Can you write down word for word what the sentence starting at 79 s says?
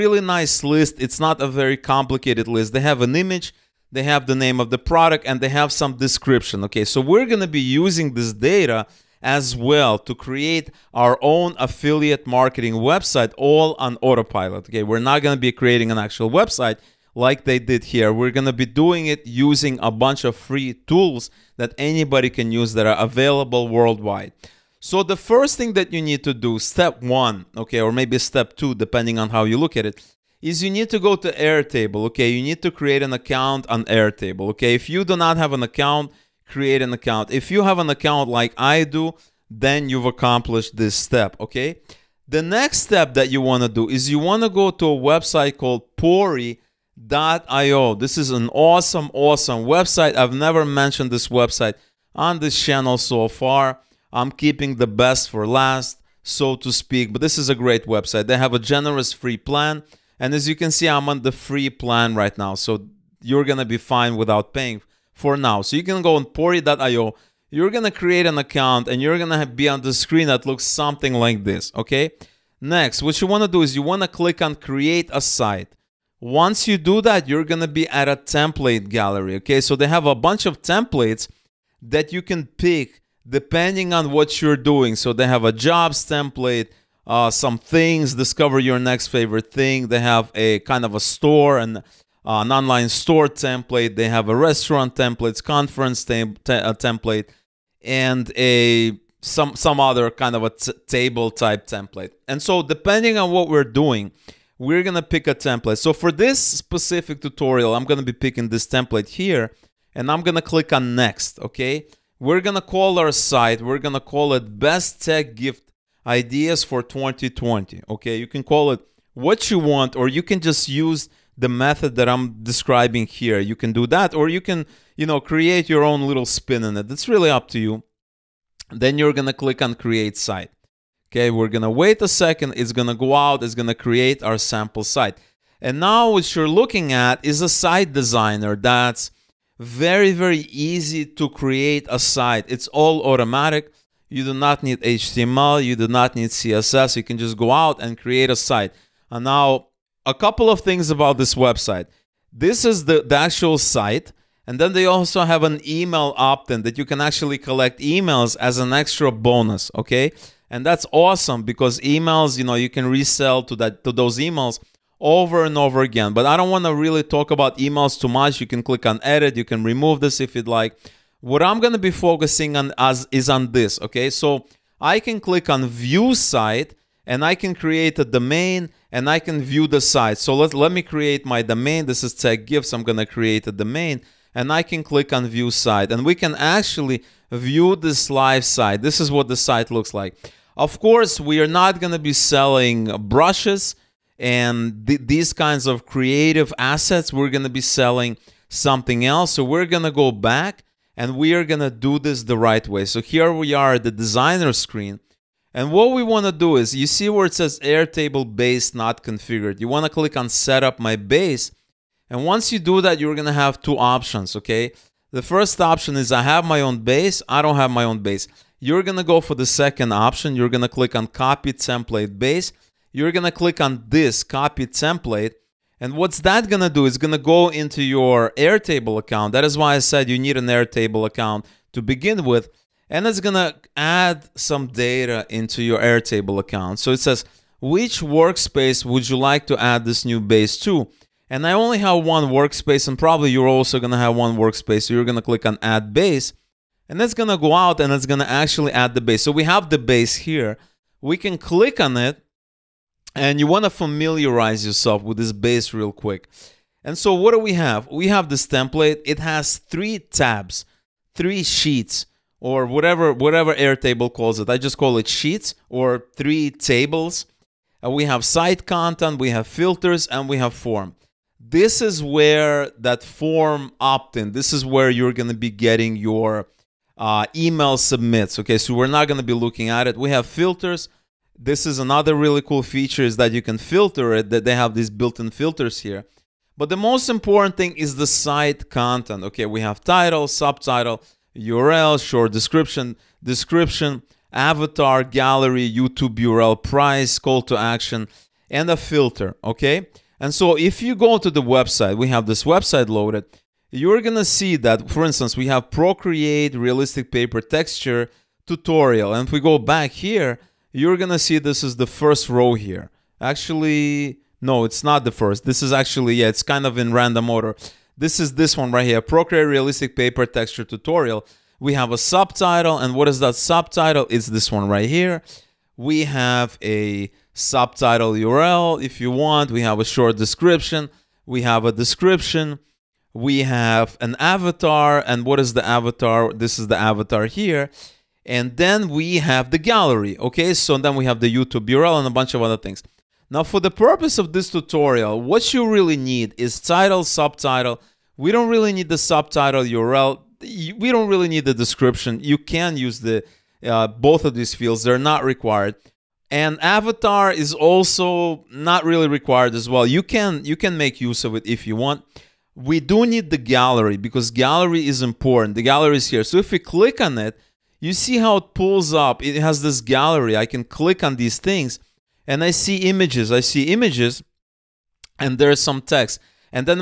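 Okay, so they have a bunch of templates that you can pick depending on what you're doing.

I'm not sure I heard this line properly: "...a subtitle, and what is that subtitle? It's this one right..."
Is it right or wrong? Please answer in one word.
right.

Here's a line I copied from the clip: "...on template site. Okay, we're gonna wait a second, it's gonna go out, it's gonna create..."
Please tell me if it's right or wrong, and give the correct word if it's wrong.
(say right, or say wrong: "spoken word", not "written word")
wrong: "create", not "template".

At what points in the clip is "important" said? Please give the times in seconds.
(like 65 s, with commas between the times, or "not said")
287 s, 365 s.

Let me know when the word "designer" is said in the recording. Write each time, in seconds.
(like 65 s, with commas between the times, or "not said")
137 s, 204 s.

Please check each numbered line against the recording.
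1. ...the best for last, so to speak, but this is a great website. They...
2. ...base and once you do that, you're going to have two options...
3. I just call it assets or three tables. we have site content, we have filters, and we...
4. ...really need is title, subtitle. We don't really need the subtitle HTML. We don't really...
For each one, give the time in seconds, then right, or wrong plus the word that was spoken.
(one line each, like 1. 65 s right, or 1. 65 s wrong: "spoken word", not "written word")
1. 54 s right
2. 210 s right
3. 264 s wrong: "sheets", not "assets"
4. 345 s wrong: "URL", not "HTML".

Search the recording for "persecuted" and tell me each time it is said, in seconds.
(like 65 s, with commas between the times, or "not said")
not said.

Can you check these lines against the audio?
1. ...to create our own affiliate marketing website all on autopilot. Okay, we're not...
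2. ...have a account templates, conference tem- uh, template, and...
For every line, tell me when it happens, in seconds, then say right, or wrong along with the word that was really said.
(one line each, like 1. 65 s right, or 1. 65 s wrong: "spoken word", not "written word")
1. 9 s right
2. 94 s wrong: "restaurant", not "account".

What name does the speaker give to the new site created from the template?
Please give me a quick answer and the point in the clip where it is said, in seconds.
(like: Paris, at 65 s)
Best tech gift ideas for 2020, at 114 s.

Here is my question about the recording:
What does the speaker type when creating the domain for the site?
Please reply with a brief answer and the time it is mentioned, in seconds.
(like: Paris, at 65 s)
tech gifts, at 182 s.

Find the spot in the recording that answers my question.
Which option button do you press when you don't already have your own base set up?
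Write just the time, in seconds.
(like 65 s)
221 s.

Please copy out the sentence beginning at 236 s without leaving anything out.
So it says, which workspace would you like to add this new base to?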